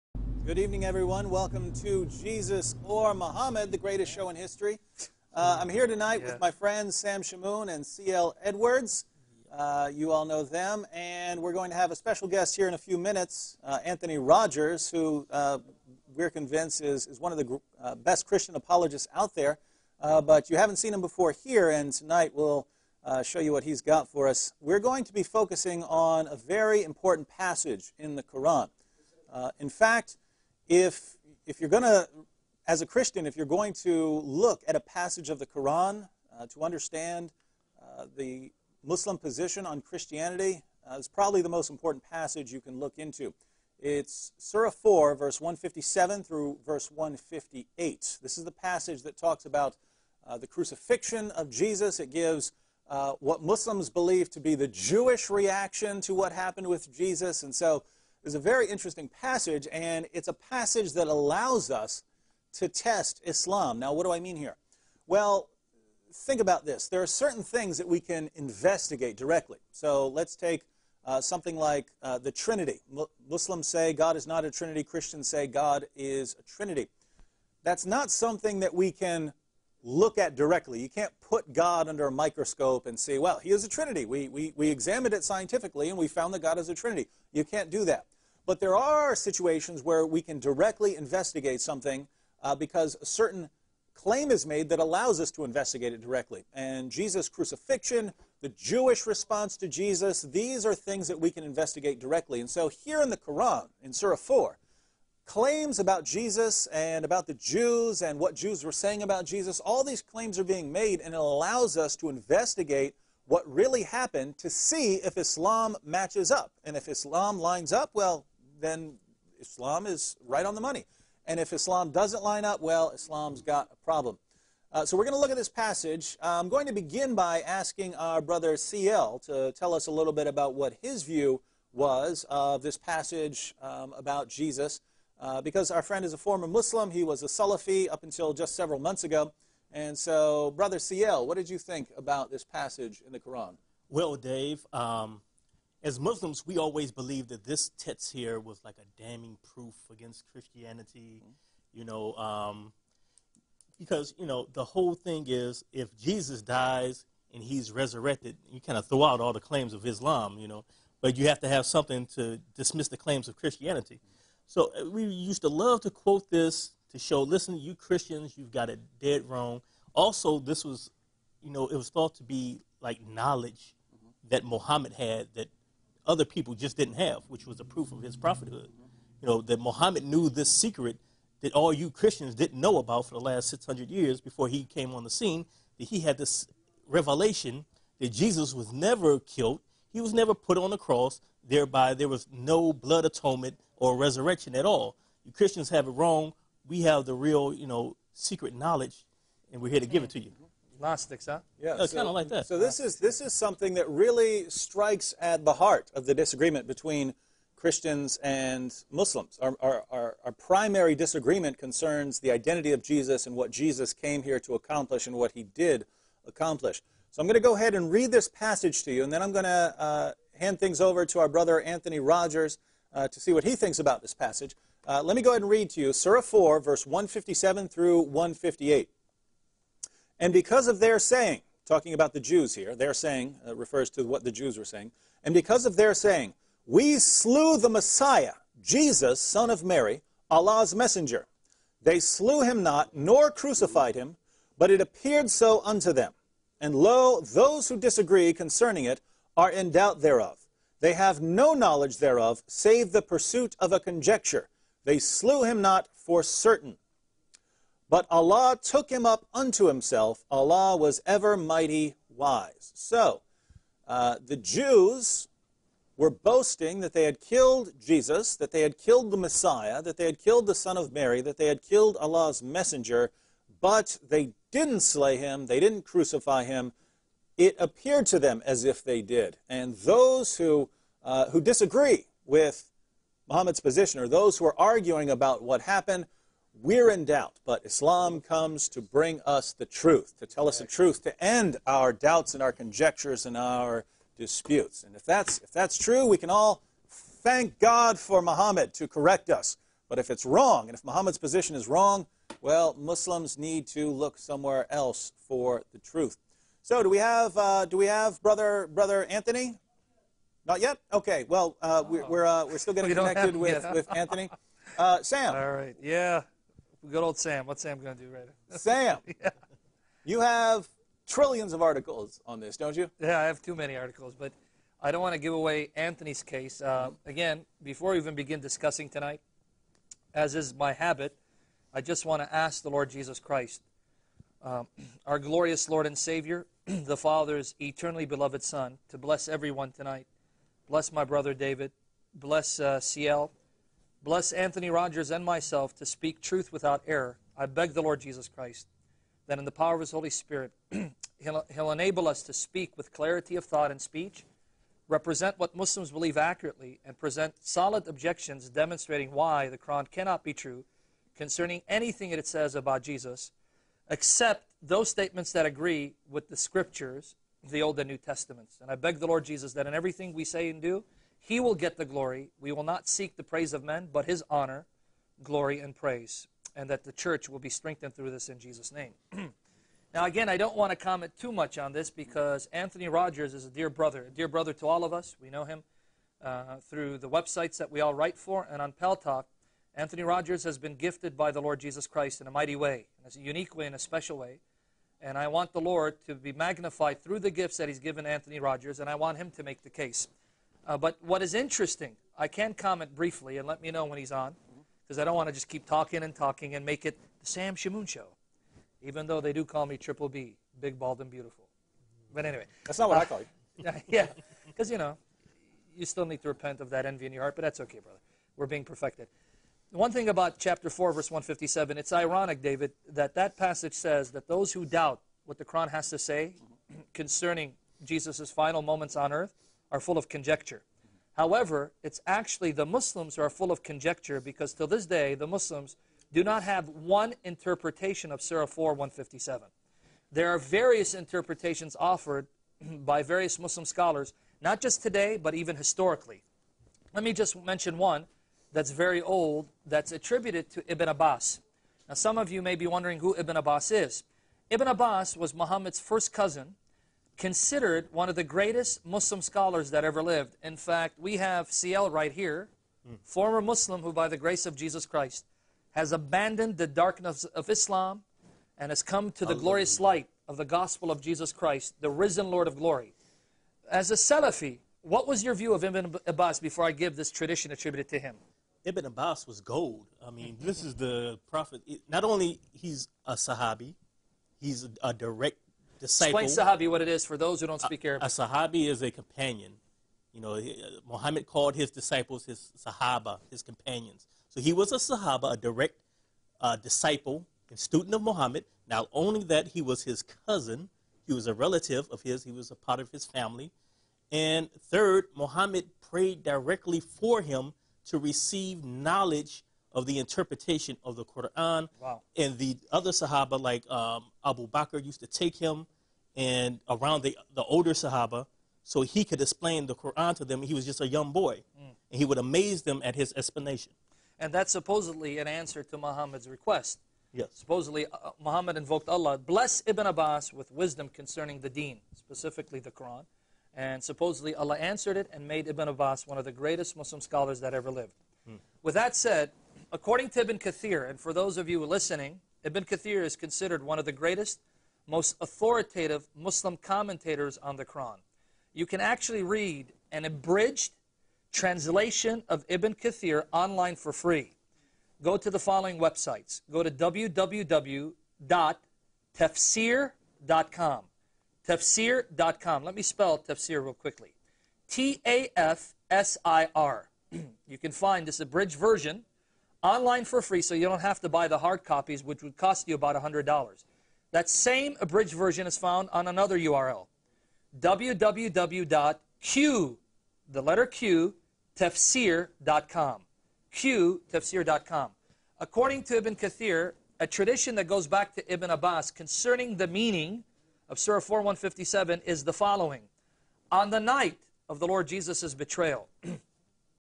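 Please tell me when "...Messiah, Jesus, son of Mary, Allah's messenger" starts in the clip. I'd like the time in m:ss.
3:57.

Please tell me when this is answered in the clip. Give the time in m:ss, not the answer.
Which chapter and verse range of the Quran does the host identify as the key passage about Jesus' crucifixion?
0:44.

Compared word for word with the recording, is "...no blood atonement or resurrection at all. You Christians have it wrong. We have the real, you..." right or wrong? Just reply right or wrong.
right.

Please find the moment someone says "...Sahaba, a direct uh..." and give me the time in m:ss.
8:14.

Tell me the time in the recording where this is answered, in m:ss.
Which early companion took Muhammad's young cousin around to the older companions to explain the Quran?
8:34.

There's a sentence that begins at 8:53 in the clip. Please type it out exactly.
And supposedly Allah answered it and made Ibn Abbas one of the greatest Muslim scholars that ever lived.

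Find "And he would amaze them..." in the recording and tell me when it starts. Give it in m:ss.
8:41.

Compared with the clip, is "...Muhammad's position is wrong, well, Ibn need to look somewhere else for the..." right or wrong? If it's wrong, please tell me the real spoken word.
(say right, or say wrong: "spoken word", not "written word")
wrong: "Muslims", not "Ibn".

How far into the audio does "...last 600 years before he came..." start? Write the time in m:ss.
3:03.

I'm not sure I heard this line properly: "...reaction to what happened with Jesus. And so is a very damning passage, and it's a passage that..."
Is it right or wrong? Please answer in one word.
wrong.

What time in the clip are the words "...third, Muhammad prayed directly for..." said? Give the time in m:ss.
8:24.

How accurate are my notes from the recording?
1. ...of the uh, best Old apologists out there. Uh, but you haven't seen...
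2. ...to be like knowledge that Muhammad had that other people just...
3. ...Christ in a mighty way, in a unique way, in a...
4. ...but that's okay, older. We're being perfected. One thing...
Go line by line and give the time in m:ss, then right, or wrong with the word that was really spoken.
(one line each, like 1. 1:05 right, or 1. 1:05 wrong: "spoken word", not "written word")
1. 0:17 wrong: "Christian", not "Old"
2. 2:52 right
3. 6:31 right
4. 6:57 wrong: "brother", not "older".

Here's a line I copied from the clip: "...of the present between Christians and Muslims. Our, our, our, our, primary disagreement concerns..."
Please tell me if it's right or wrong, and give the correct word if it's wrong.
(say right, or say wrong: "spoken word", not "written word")
wrong: "disagreement", not "present".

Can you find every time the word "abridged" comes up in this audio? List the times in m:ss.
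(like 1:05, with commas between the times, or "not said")
9:10, 9:28, 9:34.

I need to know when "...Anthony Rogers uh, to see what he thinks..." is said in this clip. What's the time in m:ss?
3:41.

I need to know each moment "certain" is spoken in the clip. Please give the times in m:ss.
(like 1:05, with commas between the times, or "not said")
1:07, 1:33, 4:16.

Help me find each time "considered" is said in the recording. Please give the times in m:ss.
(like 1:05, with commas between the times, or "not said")
7:37, 9:03.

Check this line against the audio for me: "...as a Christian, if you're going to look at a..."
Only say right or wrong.
right.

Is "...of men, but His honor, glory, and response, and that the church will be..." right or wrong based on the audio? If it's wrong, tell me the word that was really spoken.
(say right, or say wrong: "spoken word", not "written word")
wrong: "praise", not "response".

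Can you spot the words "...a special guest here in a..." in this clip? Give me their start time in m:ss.
0:11.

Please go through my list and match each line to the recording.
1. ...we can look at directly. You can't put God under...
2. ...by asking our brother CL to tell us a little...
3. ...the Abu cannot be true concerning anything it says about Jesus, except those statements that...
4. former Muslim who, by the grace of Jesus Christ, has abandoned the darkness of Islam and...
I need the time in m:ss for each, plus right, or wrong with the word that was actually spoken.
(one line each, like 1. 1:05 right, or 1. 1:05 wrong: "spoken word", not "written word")
1. 1:18 right
2. 2:07 right
3. 5:59 wrong: "Quran", not "Abu"
4. 7:43 right.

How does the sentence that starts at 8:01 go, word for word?
Not only he's a Sahabi, he's a direct disciple.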